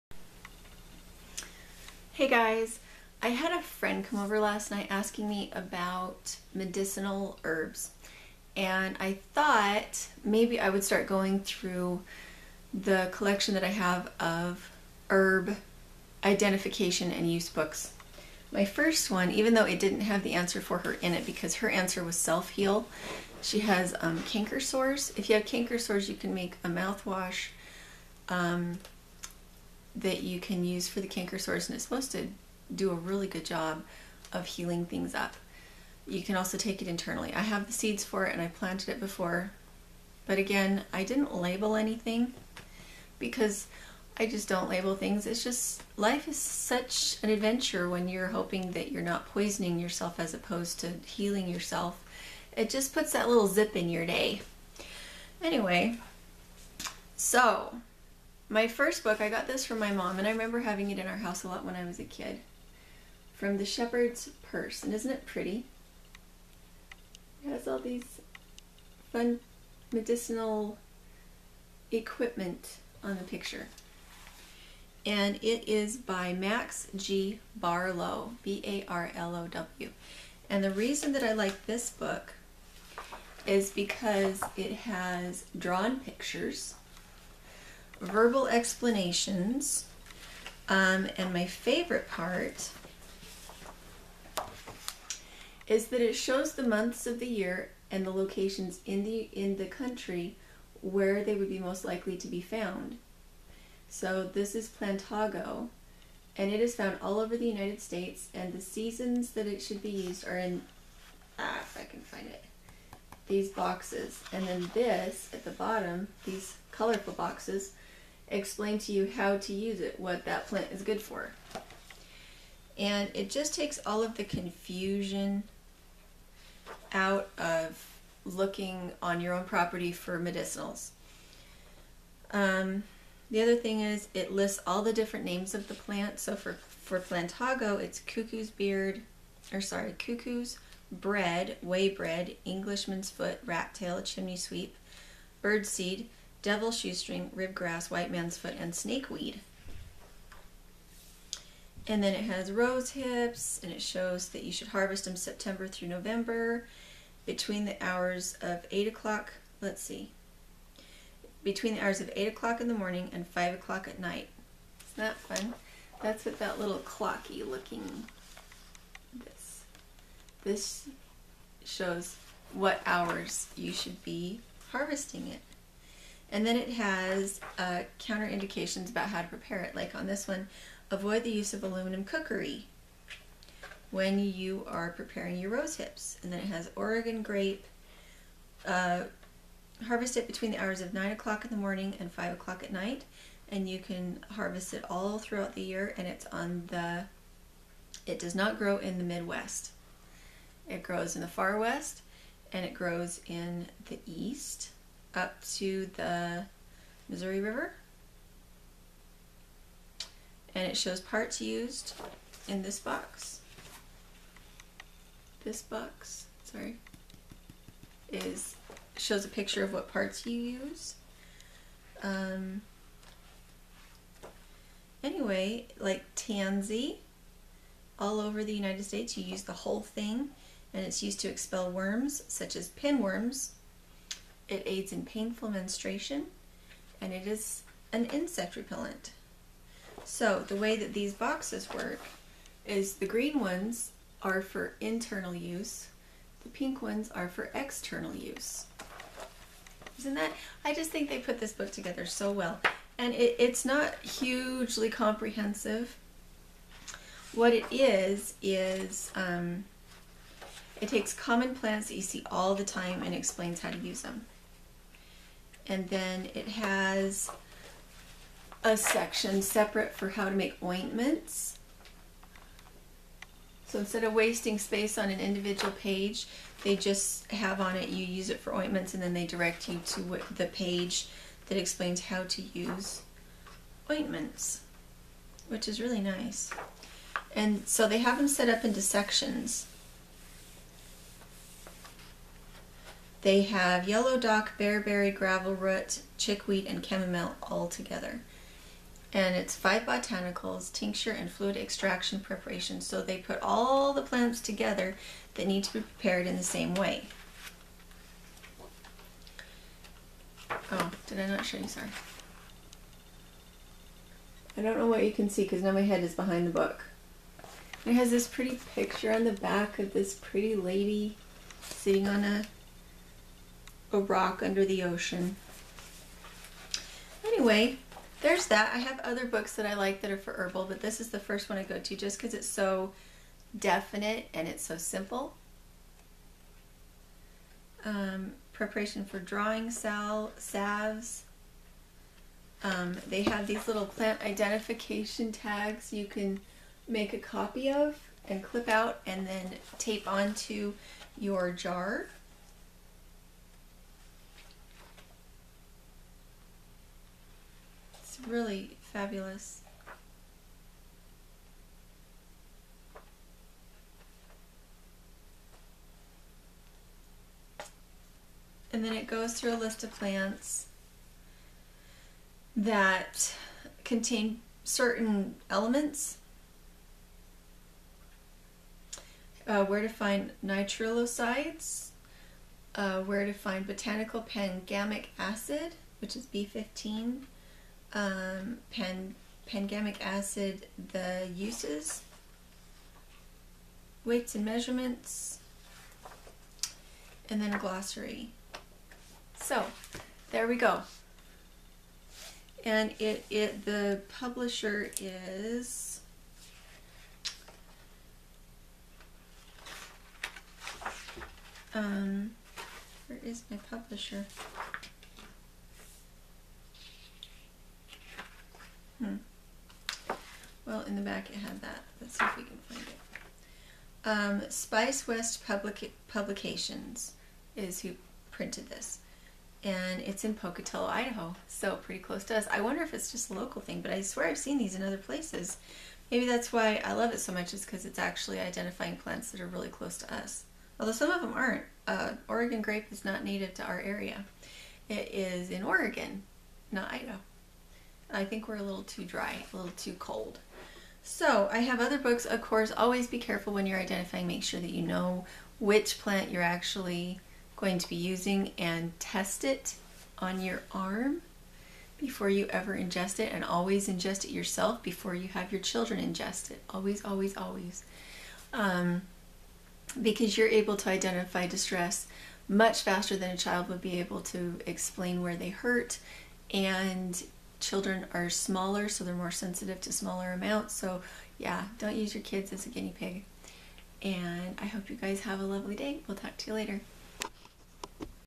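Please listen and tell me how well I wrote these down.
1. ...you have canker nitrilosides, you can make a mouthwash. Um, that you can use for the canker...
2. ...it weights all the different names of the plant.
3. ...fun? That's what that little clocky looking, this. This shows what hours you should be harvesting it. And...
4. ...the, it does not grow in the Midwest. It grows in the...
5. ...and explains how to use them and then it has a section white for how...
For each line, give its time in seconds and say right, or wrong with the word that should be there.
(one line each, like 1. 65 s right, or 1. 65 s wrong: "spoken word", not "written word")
1. 25 s wrong: "sores", not "nitrilosides"
2. 134 s wrong: "lists", not "weights"
3. 165 s right
4. 196 s right
5. 263 s wrong: "separate", not "white".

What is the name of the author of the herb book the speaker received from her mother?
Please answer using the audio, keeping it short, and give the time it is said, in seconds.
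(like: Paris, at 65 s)
Max G. Barlow, at 76 s.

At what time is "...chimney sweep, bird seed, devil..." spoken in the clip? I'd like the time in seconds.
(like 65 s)
144 s.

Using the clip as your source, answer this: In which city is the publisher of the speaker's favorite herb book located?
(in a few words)
Pocatello, Idaho.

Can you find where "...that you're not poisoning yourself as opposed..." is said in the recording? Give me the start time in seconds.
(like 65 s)
48 s.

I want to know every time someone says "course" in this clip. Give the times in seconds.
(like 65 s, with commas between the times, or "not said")
452 s.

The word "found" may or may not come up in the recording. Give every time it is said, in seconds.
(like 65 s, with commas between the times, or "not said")
102 s, 106 s.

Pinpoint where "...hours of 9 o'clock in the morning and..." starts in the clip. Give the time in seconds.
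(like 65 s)
190 s.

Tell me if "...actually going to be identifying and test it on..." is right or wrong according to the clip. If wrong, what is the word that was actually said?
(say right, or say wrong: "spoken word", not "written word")
wrong: "using", not "identifying".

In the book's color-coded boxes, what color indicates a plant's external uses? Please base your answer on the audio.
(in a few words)
Pink.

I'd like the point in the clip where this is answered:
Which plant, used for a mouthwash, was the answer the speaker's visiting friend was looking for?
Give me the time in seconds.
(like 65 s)
22 s.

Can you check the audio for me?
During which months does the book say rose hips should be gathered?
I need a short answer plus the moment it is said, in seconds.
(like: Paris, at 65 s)
September through November, at 155 s.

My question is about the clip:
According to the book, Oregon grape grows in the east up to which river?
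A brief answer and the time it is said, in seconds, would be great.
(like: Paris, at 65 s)
Missouri River, at 207 s.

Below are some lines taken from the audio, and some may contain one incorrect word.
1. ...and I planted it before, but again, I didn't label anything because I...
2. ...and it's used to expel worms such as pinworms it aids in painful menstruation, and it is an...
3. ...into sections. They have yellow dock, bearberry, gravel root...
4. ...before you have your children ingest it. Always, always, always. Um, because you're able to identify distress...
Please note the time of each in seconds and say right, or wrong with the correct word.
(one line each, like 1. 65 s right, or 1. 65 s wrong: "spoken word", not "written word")
1. 38 s right
2. 230 s right
3. 288 s right
4. 464 s right.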